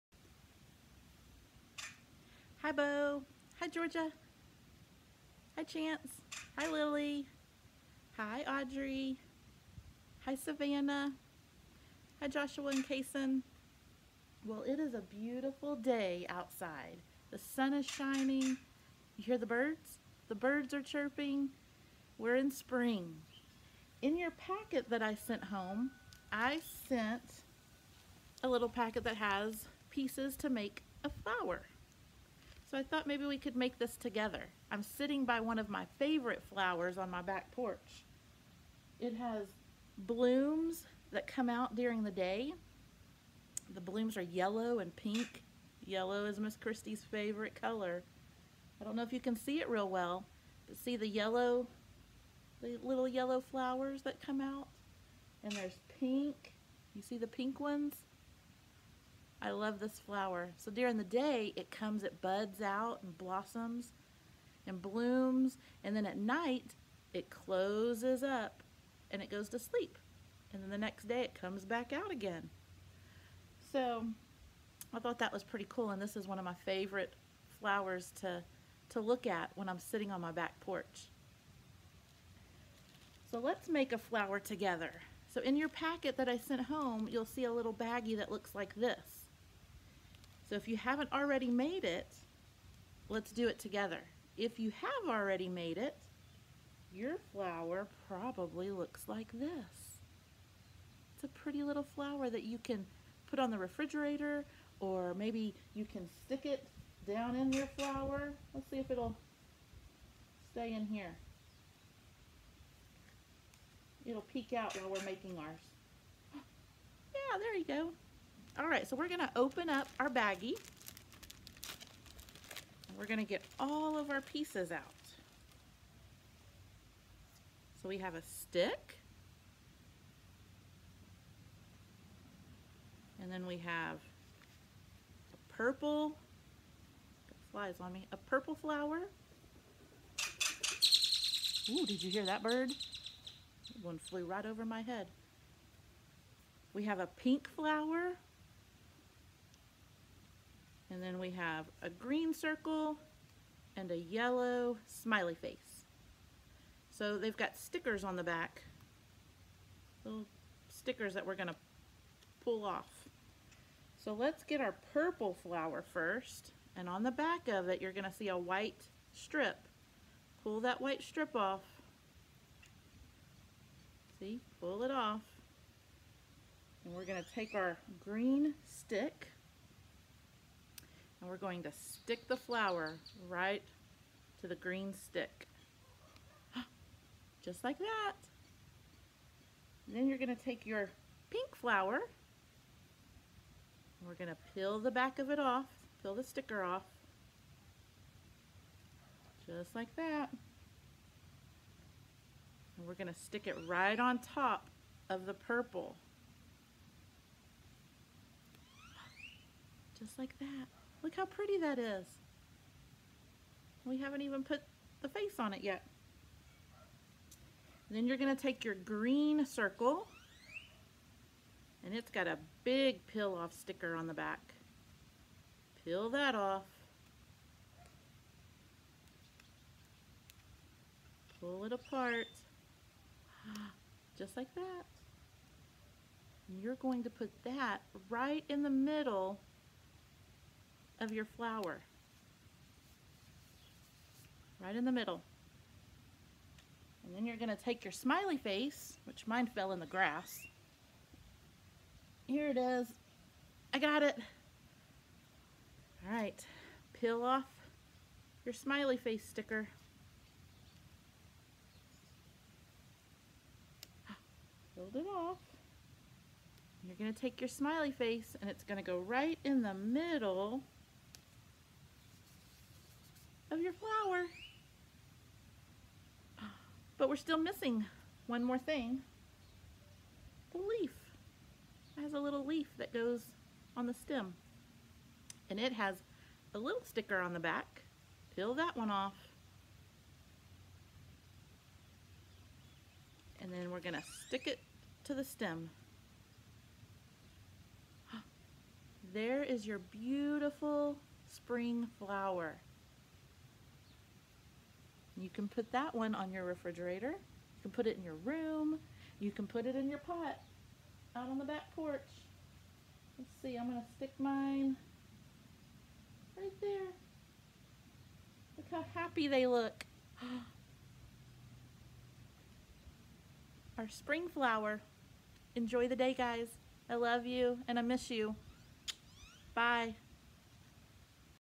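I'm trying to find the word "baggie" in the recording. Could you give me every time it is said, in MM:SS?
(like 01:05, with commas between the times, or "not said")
01:27, 02:00.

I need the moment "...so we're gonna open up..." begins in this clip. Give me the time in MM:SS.
01:58.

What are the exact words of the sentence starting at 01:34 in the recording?
If you have already made it, your flower probably looks like this.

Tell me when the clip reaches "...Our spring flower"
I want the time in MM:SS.
05:23.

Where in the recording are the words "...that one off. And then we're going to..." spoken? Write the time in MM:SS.
04:48.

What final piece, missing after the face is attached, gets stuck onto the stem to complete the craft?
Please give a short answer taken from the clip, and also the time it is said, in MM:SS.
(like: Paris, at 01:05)
The leaf, at 04:40.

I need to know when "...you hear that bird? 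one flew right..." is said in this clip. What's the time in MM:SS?
02:22.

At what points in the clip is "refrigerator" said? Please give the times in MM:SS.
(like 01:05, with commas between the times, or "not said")
01:43, 05:06.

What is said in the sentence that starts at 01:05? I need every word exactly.
And then at night, it closes up and it goes to sleep.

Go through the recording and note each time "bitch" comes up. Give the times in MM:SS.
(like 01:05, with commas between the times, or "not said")
not said.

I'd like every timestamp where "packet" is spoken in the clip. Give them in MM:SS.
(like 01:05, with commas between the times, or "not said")
00:24, 00:28, 01:25.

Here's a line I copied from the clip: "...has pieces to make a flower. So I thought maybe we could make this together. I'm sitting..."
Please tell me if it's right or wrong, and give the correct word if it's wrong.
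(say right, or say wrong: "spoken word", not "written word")
right.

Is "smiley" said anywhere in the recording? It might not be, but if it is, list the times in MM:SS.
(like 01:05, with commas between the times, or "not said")
02:34, 04:07, 04:18, 04:27.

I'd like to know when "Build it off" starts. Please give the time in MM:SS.
04:24.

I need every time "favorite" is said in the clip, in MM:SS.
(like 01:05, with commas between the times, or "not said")
00:35, 00:47, 01:16.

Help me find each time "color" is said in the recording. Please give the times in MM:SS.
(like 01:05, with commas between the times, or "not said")
00:47.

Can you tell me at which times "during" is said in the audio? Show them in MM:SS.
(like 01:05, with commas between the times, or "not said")
00:41, 01:00.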